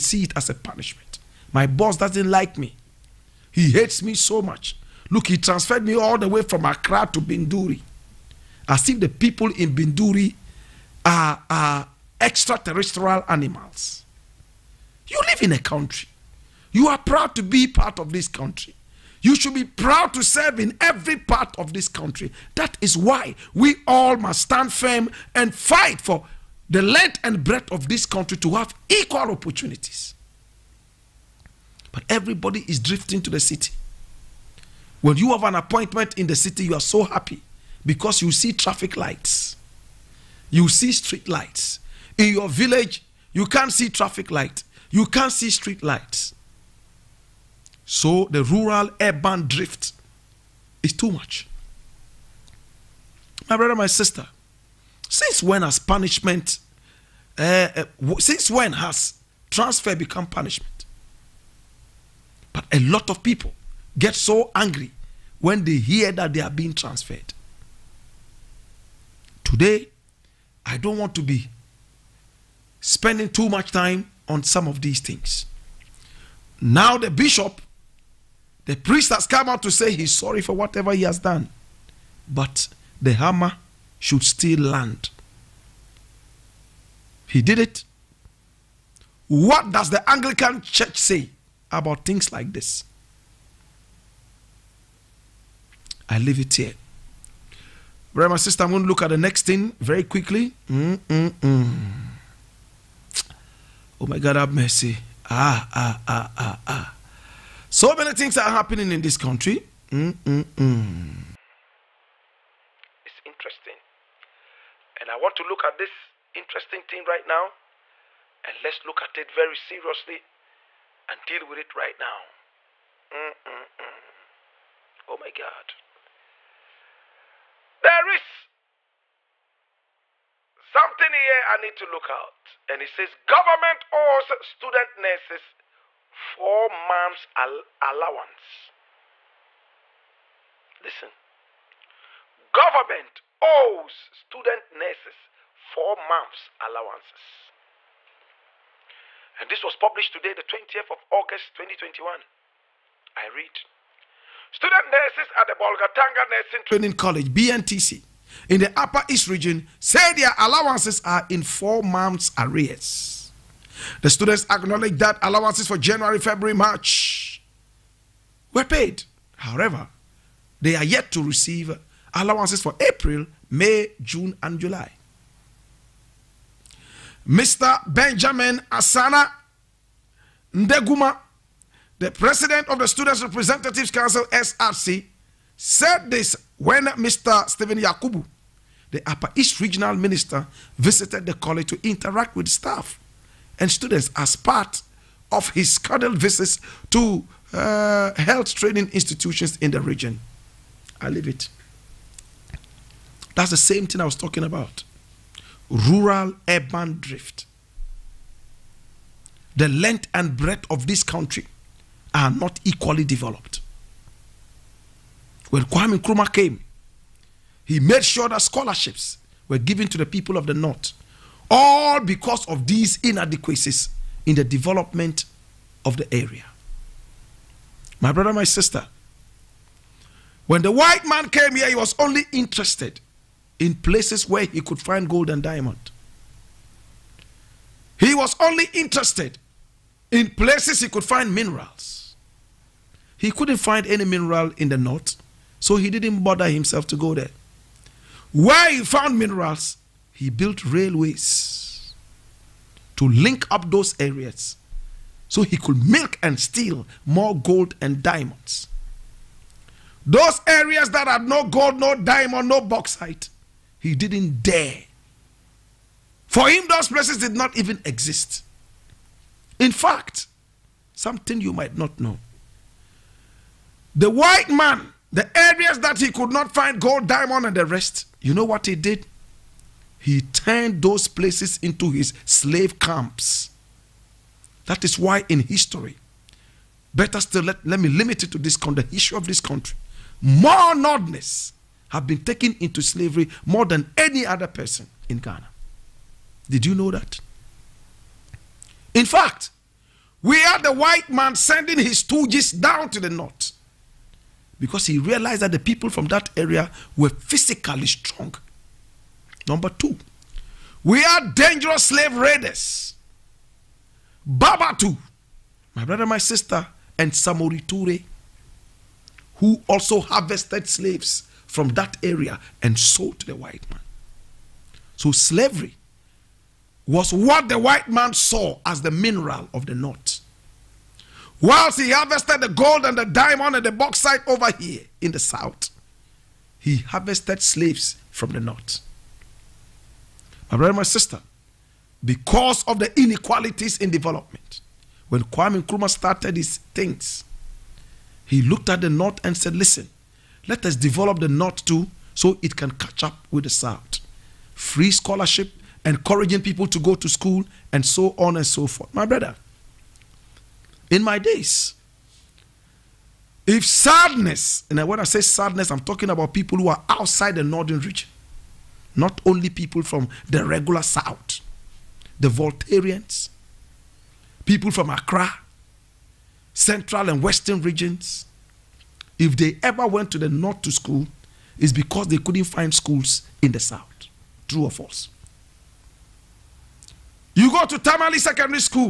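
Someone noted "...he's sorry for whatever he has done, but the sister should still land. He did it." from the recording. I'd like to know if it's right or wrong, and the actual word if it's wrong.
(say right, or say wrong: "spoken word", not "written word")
wrong: "hammer", not "sister".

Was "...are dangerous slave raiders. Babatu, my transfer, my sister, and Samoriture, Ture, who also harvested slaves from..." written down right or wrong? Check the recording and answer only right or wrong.
wrong.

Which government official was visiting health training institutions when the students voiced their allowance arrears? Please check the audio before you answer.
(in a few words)
Stephen Yakubu.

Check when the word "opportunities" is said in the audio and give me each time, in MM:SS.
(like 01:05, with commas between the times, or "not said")
00:29.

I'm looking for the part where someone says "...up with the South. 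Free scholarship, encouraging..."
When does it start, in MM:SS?
05:53.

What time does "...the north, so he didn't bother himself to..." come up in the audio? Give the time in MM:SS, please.
04:04.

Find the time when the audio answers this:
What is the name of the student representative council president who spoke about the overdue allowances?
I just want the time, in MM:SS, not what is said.
02:57.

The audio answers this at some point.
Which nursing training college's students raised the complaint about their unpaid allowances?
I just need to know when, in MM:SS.
02:35.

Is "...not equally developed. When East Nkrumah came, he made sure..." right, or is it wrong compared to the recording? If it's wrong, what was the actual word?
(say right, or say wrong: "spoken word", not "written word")
wrong: "Kwame", not "East".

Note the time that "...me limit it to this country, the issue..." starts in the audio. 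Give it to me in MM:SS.
04:47.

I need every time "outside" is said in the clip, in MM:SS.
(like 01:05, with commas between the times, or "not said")
06:06.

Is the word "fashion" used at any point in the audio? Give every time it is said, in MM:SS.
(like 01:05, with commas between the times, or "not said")
not said.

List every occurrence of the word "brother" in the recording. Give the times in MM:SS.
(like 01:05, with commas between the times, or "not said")
00:53, 01:38, 03:48, 05:15, 05:40, 05:59.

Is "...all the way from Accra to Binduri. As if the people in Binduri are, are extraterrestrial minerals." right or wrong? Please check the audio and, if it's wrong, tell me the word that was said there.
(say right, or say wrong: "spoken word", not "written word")
wrong: "animals", not "minerals".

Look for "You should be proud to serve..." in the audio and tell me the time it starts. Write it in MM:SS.
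00:19.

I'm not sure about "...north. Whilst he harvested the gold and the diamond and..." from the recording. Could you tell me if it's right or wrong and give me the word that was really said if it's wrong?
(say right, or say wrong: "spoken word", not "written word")
right.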